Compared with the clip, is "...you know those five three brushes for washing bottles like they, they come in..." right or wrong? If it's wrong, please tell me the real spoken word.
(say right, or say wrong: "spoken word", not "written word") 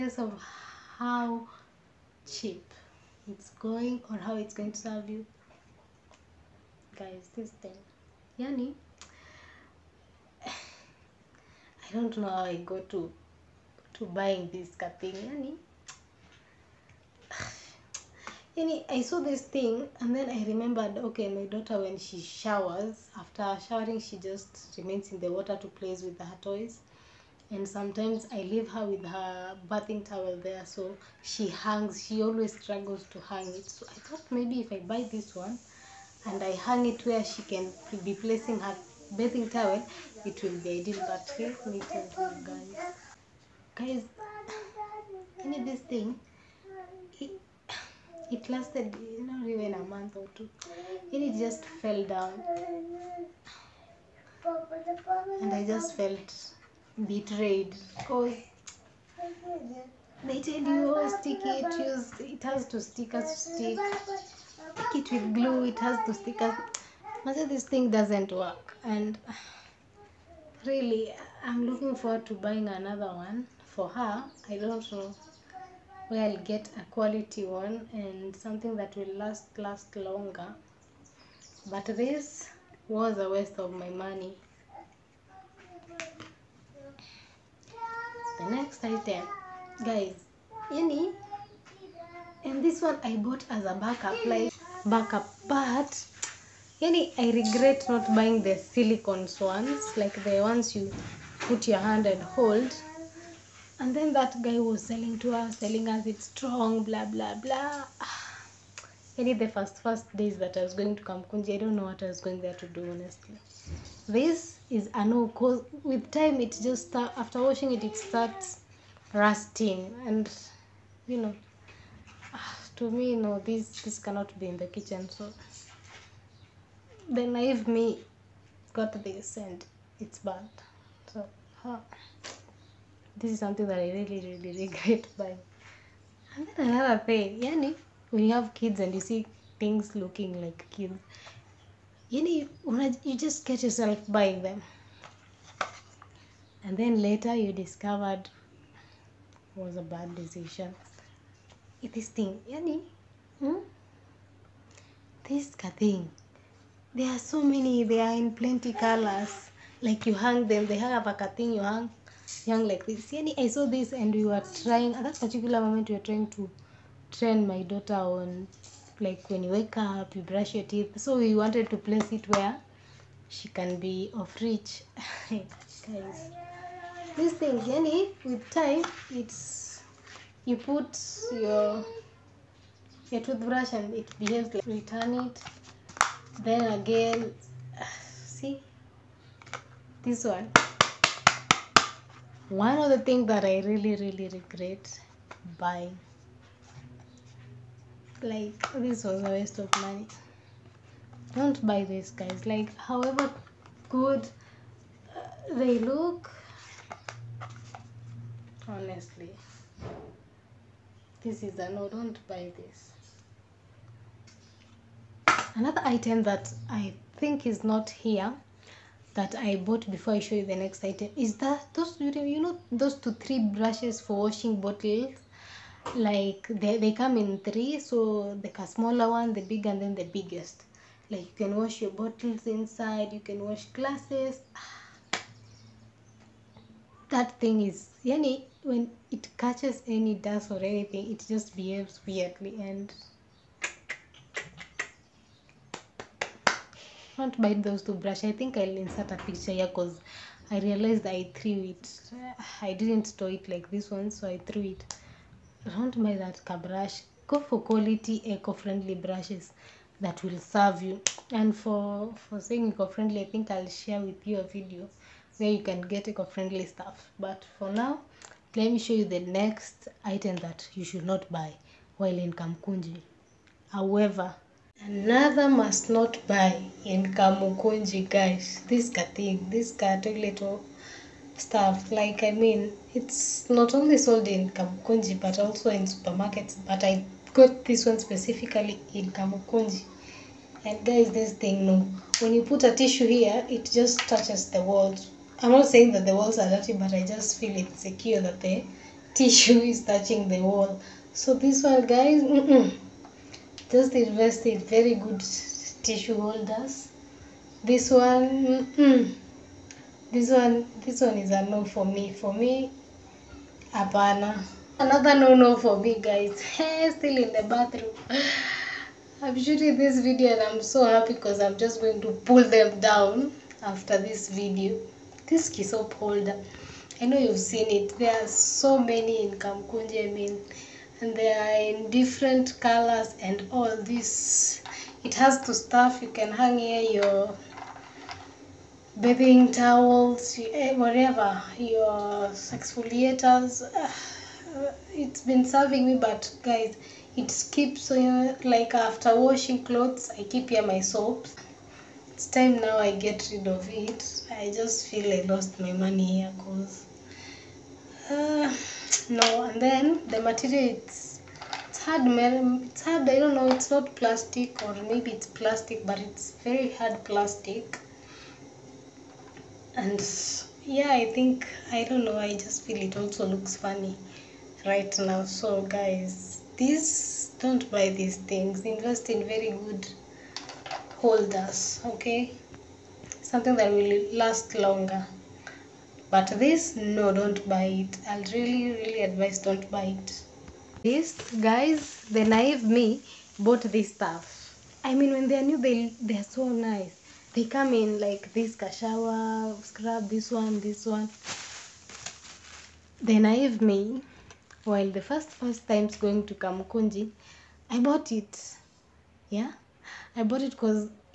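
wrong: "two", not "five".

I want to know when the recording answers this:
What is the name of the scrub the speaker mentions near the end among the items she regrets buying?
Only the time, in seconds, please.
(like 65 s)
398 s.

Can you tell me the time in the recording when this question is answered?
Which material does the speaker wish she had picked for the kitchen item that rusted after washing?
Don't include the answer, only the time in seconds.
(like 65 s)
98 s.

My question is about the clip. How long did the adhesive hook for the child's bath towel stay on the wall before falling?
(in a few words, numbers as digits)
Not even a month or two.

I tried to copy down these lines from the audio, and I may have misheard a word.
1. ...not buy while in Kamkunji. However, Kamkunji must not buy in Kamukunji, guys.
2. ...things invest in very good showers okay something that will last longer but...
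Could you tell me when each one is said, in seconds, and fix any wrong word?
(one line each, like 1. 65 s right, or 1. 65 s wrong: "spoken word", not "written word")
1. 271 s wrong: "Another", not "Kamkunji"
2. 378 s wrong: "holders", not "showers".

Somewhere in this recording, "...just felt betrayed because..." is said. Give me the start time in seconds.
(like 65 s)
55 s.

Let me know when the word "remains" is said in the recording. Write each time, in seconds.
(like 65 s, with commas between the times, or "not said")
24 s.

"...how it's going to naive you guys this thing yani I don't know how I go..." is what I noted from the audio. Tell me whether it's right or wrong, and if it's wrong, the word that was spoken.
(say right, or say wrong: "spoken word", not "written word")
wrong: "serve", not "naive".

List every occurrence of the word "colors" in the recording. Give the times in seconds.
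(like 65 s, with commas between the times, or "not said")
158 s, 332 s.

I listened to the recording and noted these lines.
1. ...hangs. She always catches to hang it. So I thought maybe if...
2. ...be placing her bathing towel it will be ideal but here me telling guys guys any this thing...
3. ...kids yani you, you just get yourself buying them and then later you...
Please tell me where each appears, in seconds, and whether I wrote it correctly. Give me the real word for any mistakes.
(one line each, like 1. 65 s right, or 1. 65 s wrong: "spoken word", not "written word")
1. 31 s wrong: "struggles", not "catches"
2. 38 s right
3. 140 s right.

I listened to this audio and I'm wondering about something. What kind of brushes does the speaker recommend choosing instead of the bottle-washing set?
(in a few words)
Eco-friendly brushes.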